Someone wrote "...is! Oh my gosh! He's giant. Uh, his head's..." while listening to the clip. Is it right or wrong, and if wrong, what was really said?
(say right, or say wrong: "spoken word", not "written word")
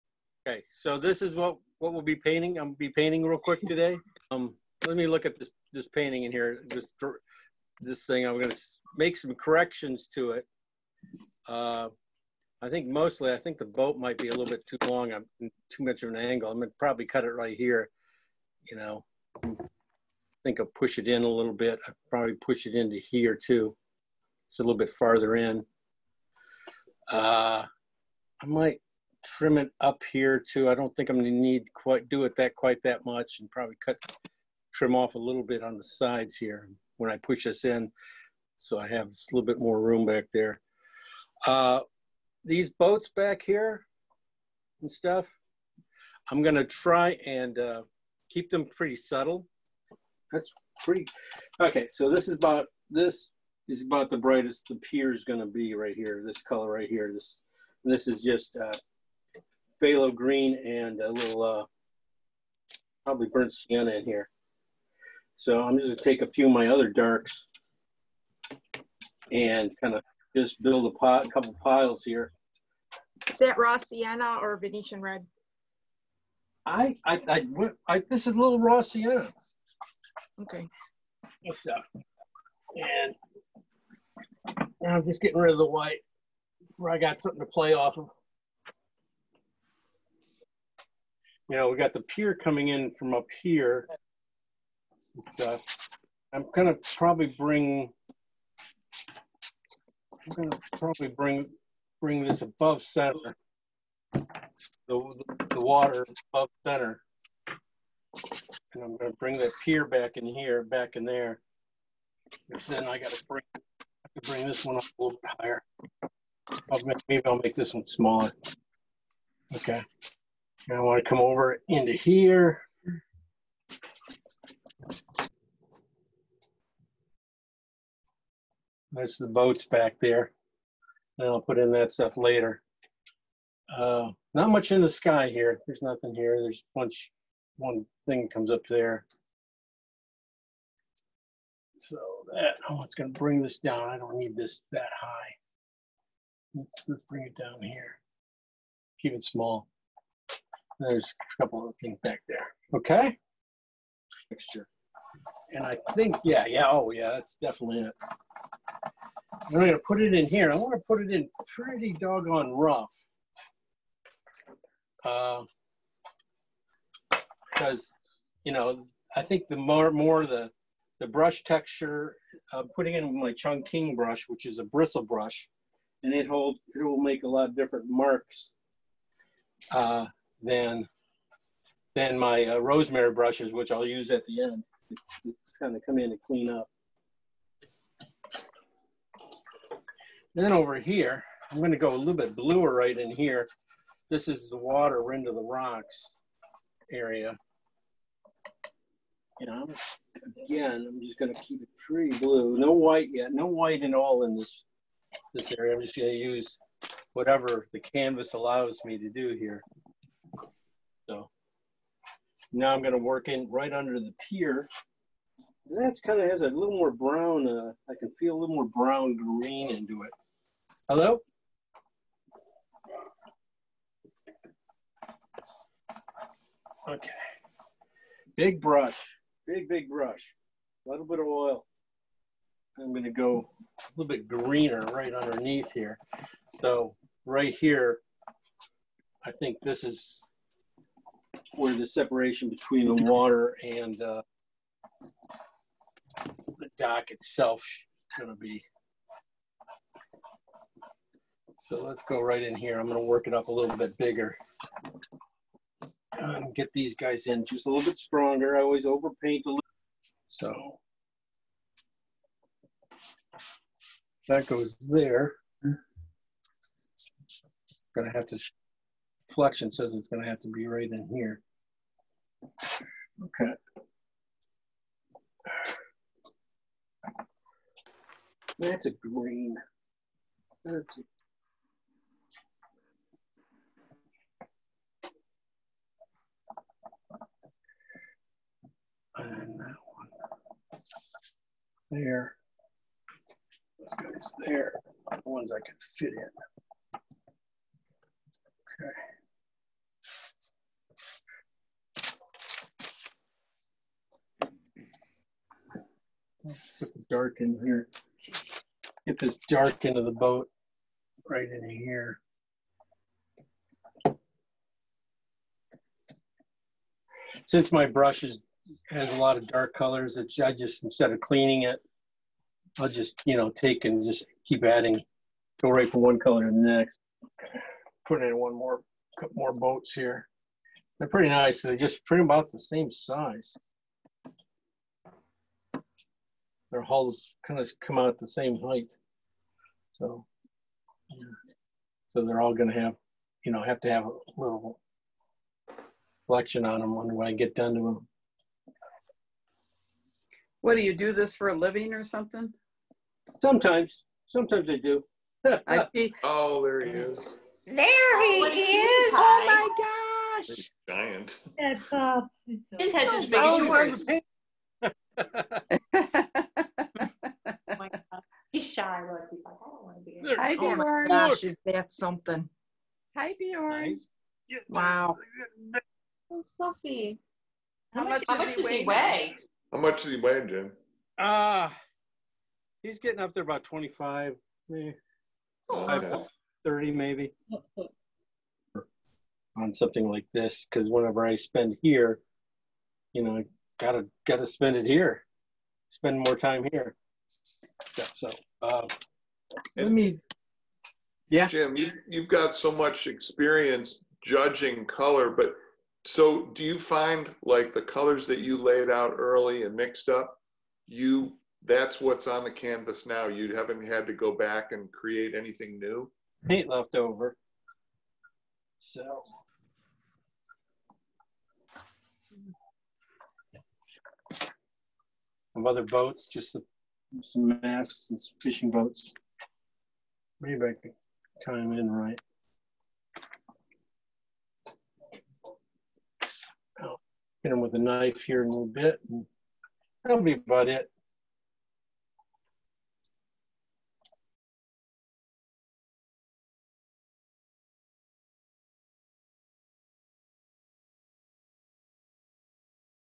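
right.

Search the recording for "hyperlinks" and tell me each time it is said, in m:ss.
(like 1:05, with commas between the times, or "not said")
not said.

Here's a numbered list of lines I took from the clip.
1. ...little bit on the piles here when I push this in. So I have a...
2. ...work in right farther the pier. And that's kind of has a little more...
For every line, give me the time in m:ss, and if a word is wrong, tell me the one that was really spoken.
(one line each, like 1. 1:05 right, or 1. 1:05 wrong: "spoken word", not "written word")
1. 0:35 wrong: "sides", not "piles"
2. 3:32 wrong: "under", not "farther".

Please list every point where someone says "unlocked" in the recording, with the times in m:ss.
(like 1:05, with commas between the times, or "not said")
not said.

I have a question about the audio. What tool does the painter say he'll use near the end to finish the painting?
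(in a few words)
A knife.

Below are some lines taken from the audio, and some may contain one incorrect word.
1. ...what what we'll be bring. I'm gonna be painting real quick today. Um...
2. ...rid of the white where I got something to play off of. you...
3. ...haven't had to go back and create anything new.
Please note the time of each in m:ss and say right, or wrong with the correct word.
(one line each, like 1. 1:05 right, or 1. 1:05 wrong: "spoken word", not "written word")
1. 0:01 wrong: "painting", not "bring"
2. 1:25 right
3. 6:53 right.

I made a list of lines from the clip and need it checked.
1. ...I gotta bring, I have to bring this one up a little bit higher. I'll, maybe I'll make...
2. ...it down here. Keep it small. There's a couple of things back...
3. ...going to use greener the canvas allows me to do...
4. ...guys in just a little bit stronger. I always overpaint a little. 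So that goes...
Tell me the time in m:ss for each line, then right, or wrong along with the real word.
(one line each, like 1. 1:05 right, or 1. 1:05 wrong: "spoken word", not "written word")
1. 1:52 right
2. 2:27 right
3. 3:25 wrong: "whatever", not "greener"
4. 4:16 right.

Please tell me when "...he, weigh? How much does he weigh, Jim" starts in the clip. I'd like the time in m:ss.
6:18.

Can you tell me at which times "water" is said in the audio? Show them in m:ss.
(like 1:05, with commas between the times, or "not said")
1:45, 3:14, 4:03.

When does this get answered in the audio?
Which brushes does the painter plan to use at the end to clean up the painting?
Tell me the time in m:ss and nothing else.
3:02.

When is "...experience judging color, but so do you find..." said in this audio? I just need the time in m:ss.
6:43.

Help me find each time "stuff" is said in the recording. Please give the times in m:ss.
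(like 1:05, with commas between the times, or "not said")
0:44, 1:35, 2:11.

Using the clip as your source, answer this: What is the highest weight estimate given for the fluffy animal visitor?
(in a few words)
30.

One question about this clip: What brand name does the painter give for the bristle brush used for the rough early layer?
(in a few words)
Chungking.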